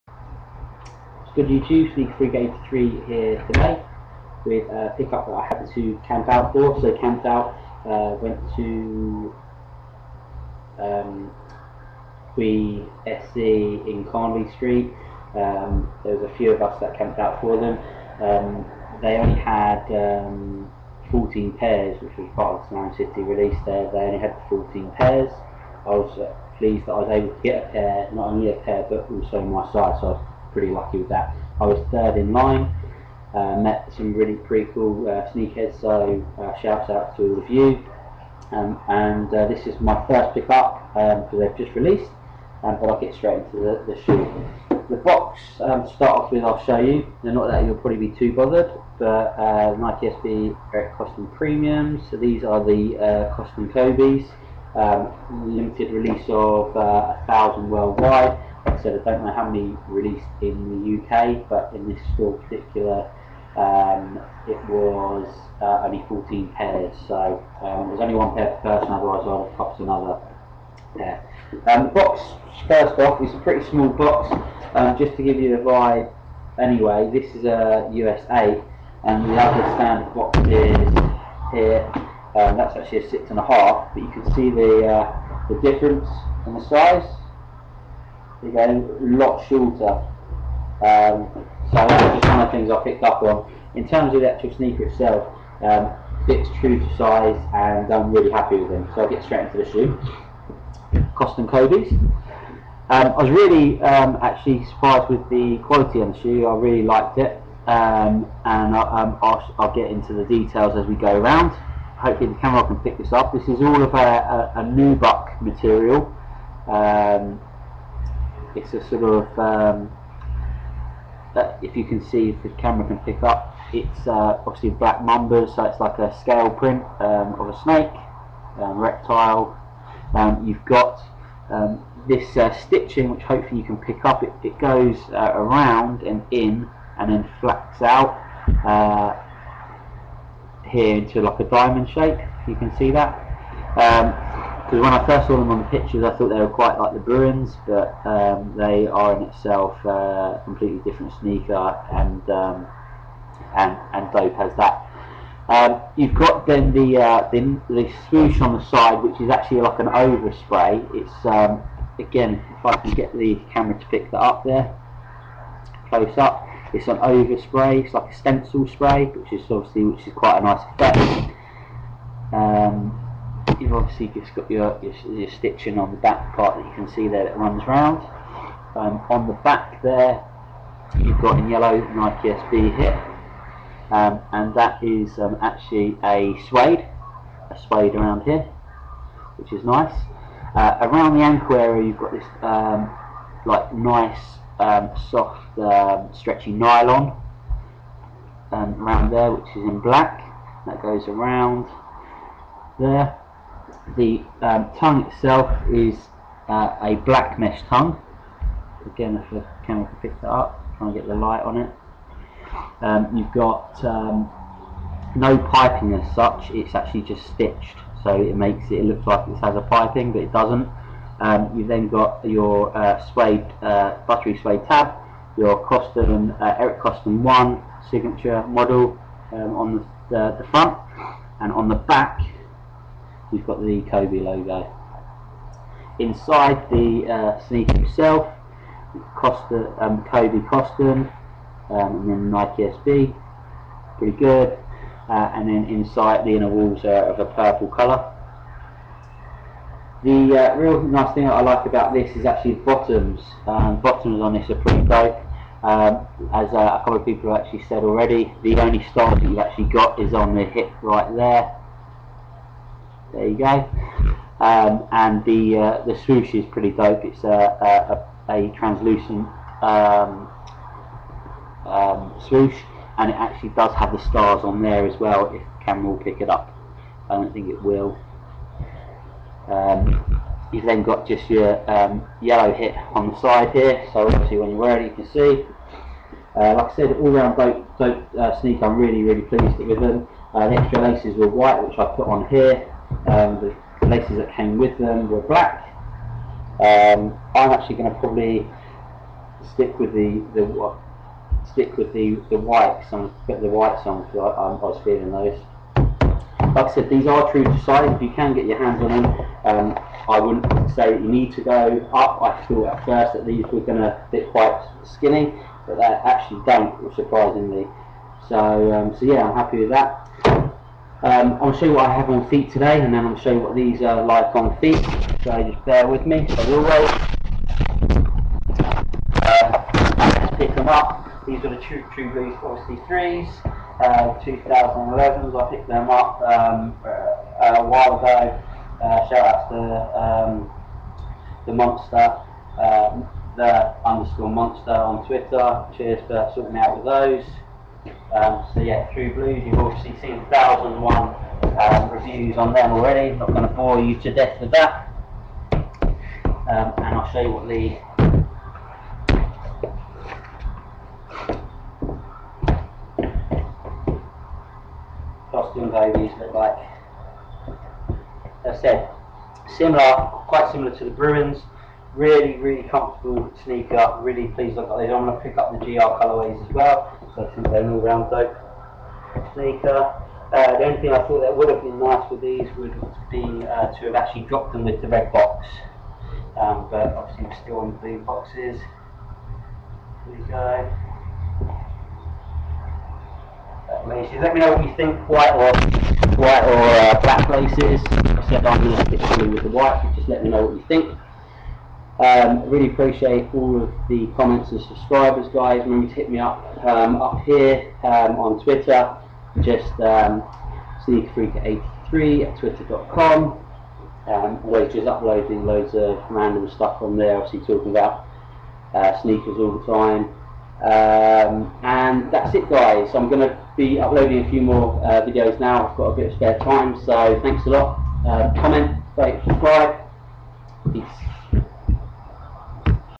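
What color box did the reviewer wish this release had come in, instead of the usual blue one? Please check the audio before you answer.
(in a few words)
Red.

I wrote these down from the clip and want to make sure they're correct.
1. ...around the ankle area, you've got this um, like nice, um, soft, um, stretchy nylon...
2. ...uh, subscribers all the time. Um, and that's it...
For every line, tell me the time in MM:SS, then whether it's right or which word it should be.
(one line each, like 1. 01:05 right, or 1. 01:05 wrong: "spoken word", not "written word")
1. 03:10 right
2. 06:58 wrong: "sneakers", not "subscribers".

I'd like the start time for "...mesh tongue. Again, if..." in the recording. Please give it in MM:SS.
03:27.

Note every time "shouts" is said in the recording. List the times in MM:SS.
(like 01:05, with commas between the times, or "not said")
00:36, 05:39.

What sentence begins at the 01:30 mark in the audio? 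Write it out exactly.
Um, so that's just one of the things I picked up on.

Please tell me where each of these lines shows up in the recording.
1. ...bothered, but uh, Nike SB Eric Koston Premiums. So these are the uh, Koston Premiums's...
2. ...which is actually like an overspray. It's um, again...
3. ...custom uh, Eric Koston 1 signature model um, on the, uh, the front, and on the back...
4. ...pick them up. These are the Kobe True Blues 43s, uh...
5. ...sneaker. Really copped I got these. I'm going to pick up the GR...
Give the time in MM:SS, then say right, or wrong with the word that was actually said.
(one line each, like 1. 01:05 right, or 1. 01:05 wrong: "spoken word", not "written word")
1. 00:48 wrong: "Kobe", not "Premiums"
2. 02:39 right
3. 03:45 right
4. 05:30 wrong: "True", not "Kobe"
5. 06:13 wrong: "pleased", not "copped".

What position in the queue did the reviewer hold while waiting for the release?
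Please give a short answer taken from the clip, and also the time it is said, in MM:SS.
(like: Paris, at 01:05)
Third, at 00:31.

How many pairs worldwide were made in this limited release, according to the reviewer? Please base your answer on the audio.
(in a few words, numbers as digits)
1,000.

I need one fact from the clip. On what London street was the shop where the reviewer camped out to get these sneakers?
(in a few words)
Carnaby Street.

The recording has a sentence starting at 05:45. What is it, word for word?
Cheers for sorting me out with those.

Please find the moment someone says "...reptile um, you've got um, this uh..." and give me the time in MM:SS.
02:08.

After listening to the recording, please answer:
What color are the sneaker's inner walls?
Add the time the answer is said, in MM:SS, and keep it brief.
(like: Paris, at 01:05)
Purple, at 04:07.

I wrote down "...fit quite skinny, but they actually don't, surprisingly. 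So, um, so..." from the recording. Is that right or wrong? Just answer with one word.
right.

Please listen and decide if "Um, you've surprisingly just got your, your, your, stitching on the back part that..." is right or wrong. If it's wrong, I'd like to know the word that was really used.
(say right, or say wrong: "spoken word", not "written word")
wrong: "obviously", not "surprisingly".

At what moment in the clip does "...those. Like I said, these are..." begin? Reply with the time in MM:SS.
05:05.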